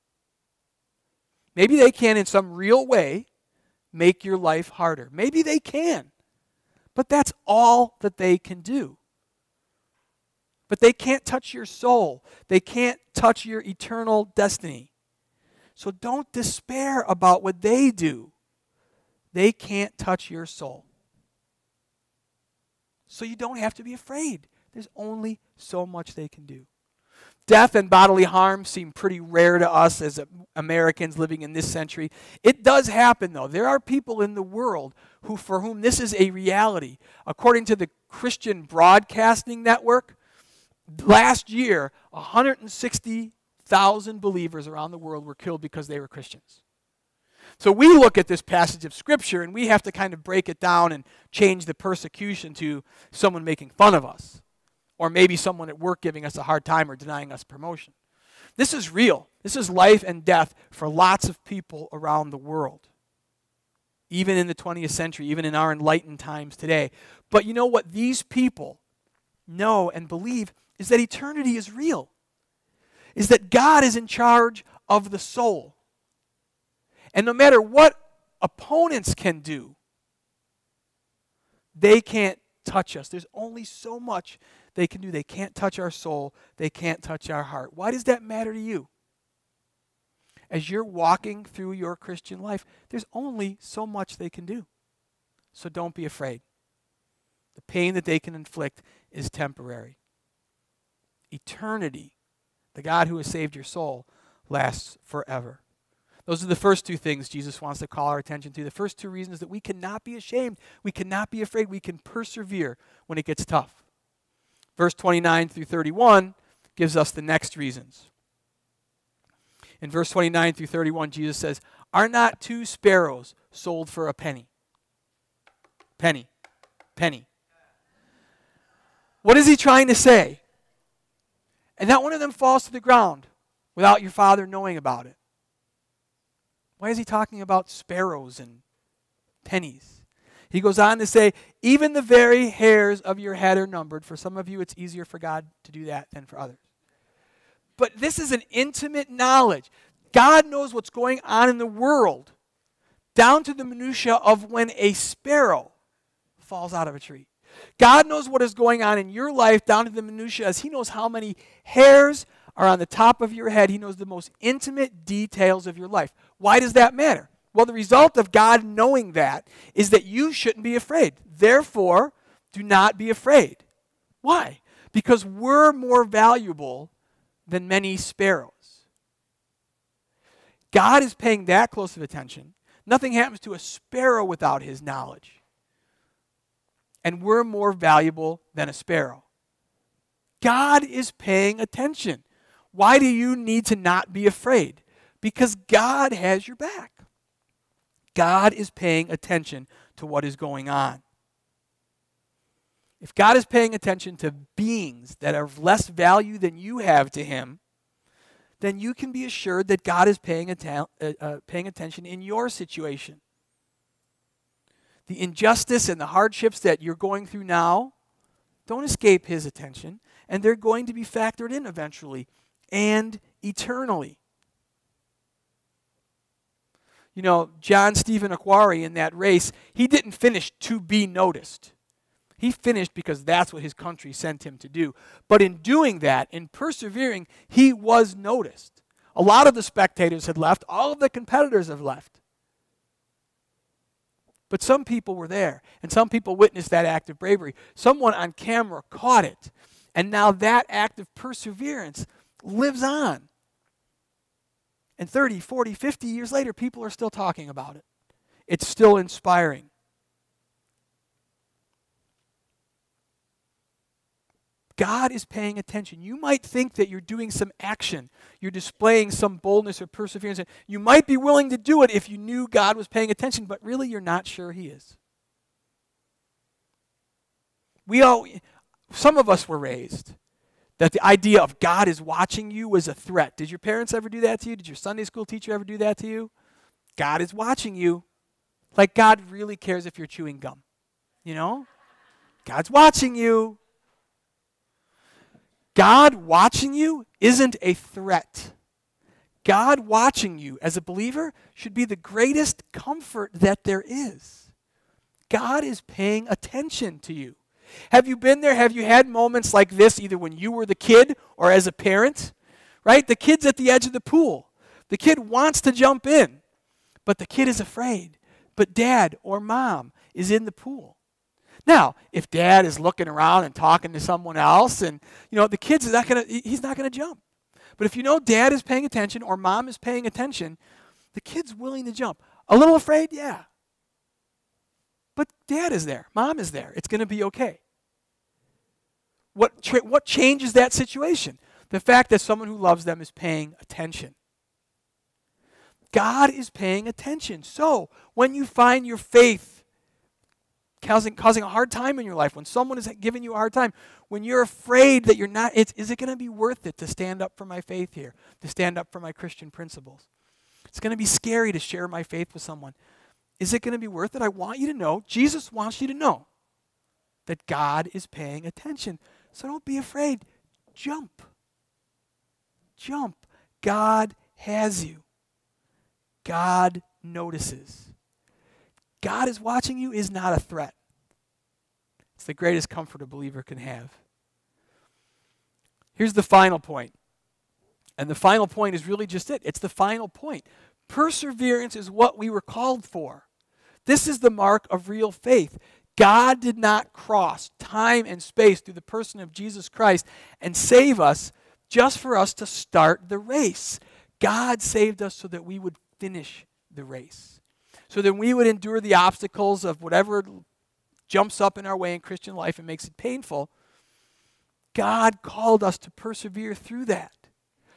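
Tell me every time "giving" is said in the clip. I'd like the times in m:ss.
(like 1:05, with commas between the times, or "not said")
0:56, 5:52.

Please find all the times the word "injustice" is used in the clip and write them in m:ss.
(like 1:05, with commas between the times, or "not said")
3:35.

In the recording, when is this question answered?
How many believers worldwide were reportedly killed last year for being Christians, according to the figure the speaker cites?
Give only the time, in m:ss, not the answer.
0:42.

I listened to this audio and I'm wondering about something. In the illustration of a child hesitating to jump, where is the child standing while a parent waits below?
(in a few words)
edge of the pool.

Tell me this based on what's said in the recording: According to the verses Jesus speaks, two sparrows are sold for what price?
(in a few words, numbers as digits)
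a penny.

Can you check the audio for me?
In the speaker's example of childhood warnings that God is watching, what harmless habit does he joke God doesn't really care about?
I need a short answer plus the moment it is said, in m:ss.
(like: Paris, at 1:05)
chewing gum, at 4:50.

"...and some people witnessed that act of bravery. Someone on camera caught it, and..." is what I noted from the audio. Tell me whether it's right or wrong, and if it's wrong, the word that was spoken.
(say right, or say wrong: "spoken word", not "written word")
right.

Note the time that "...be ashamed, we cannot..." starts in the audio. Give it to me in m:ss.
1:50.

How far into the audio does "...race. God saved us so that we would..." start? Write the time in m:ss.
6:43.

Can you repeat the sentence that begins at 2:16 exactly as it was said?
Why is he talking about sparrows and pennies?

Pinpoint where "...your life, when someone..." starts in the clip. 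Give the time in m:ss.
5:52.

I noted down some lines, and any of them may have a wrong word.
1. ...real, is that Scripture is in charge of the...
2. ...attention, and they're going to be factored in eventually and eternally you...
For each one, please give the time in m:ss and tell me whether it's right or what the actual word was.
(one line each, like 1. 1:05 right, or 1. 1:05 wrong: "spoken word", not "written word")
1. 1:11 wrong: "God", not "Scripture"
2. 3:39 right.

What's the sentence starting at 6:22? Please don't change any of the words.
It's the greatest comfort a believer can have.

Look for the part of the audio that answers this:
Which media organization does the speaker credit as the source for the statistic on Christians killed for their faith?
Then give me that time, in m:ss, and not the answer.
0:38.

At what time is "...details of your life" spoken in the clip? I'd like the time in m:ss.
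2:45.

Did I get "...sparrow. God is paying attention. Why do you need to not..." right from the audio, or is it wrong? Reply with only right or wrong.
right.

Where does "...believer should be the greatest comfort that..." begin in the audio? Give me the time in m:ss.
5:00.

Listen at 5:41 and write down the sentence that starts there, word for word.
The fact that someone who loves them is paying attention.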